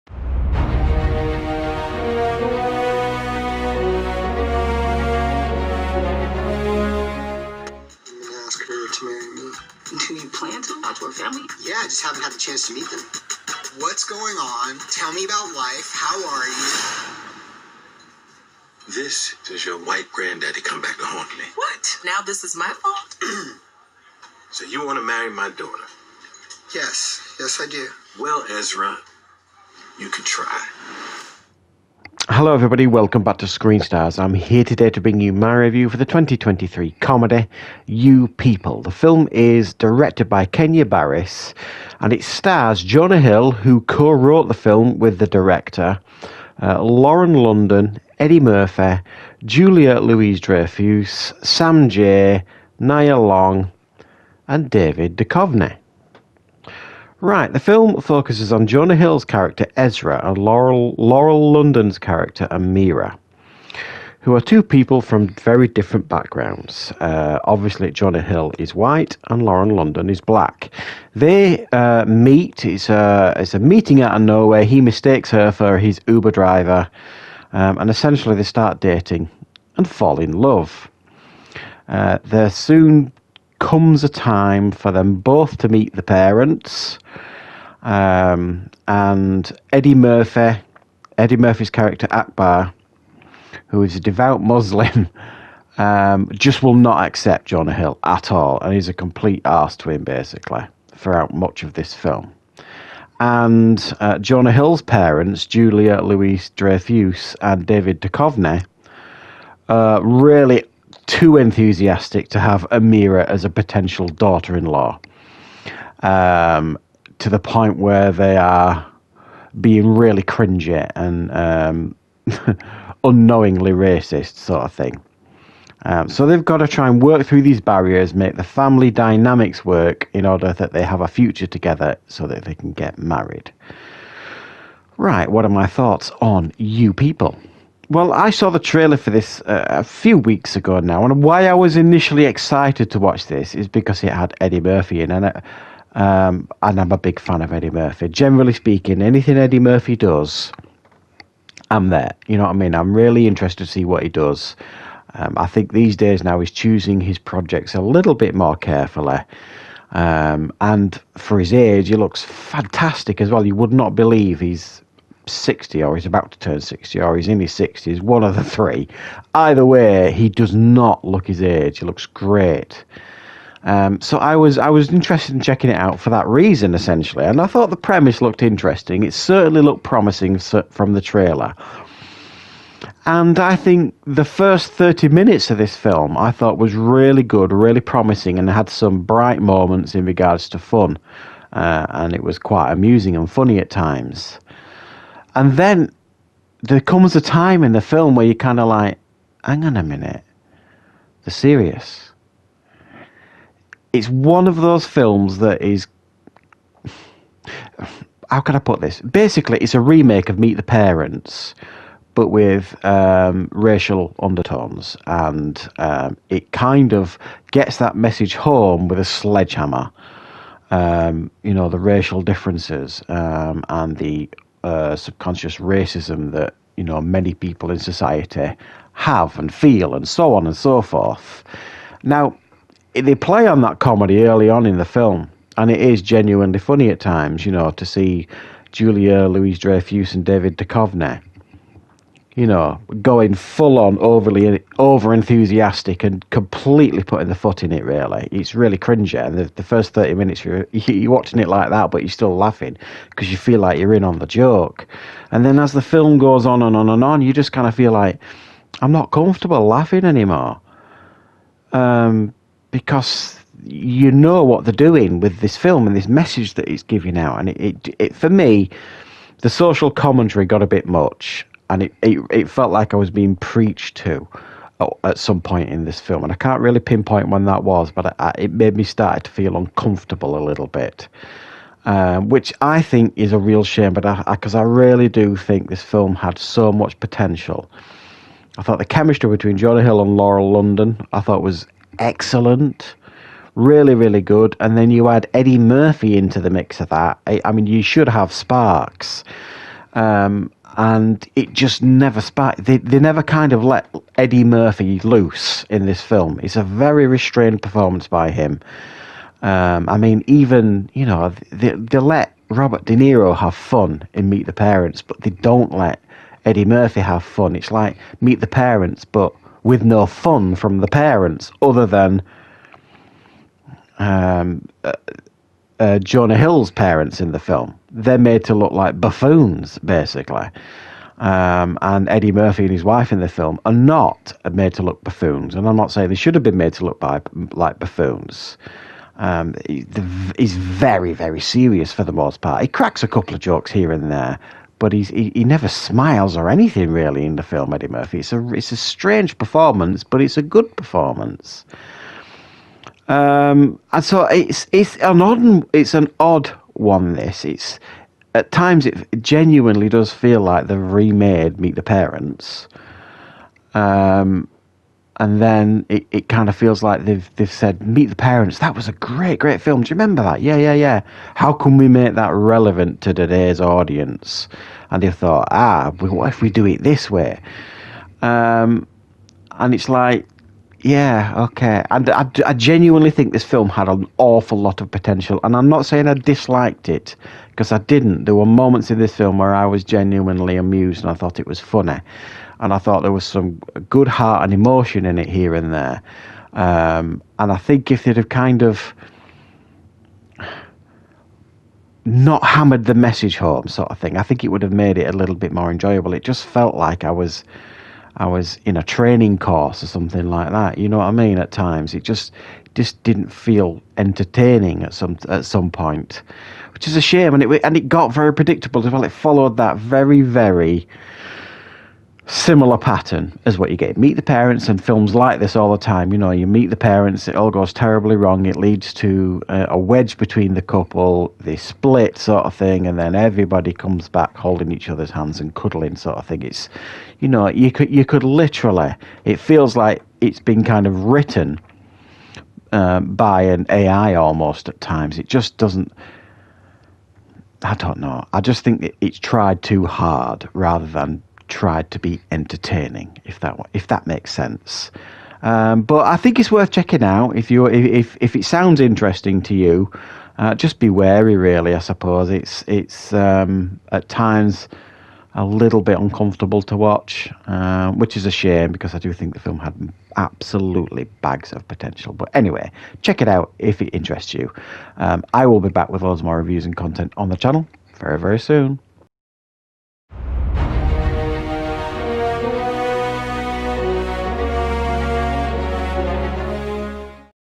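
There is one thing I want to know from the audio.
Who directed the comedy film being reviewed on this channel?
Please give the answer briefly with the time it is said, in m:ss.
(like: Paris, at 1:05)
Kenya Barris, at 0:40.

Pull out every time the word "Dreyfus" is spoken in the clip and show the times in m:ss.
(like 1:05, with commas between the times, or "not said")
0:50, 1:46, 3:59.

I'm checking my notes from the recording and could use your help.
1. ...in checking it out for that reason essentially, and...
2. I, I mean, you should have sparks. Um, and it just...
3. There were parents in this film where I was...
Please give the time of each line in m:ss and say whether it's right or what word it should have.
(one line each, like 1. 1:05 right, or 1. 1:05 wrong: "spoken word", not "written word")
1. 2:55 right
2. 4:57 right
3. 6:28 wrong: "moments", not "parents".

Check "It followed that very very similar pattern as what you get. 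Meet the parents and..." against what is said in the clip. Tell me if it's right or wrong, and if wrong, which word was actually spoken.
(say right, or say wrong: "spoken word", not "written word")
right.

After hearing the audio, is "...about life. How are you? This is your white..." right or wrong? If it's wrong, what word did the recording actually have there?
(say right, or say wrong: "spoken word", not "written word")
right.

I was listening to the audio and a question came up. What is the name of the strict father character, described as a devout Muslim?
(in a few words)
Akbar.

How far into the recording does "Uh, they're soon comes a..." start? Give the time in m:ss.
1:21.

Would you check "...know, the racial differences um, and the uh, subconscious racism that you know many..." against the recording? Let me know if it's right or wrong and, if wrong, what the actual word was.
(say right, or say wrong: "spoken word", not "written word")
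right.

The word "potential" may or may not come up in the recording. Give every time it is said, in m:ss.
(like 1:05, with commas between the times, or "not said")
1:53, 4:46, 6:24, 7:51.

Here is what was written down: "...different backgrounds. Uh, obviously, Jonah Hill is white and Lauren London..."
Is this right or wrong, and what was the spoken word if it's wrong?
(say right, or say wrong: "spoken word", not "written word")
right.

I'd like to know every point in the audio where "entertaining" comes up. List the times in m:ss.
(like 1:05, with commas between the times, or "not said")
6:53, 7:32.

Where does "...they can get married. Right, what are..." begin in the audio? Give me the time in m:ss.
2:12.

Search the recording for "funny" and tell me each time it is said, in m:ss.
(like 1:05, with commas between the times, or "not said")
3:13, 3:56, 6:31.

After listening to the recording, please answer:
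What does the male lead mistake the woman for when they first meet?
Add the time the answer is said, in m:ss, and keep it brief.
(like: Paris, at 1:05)
his Uber driver, at 1:15.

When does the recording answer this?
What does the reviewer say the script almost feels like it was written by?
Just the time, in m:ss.
7:23.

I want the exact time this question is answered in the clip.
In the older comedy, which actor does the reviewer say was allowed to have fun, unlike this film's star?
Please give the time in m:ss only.
5:12.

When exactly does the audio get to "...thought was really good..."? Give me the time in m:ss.
3:06.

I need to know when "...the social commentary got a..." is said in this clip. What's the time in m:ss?
4:29.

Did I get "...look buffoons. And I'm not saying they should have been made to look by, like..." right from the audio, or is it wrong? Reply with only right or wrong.
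right.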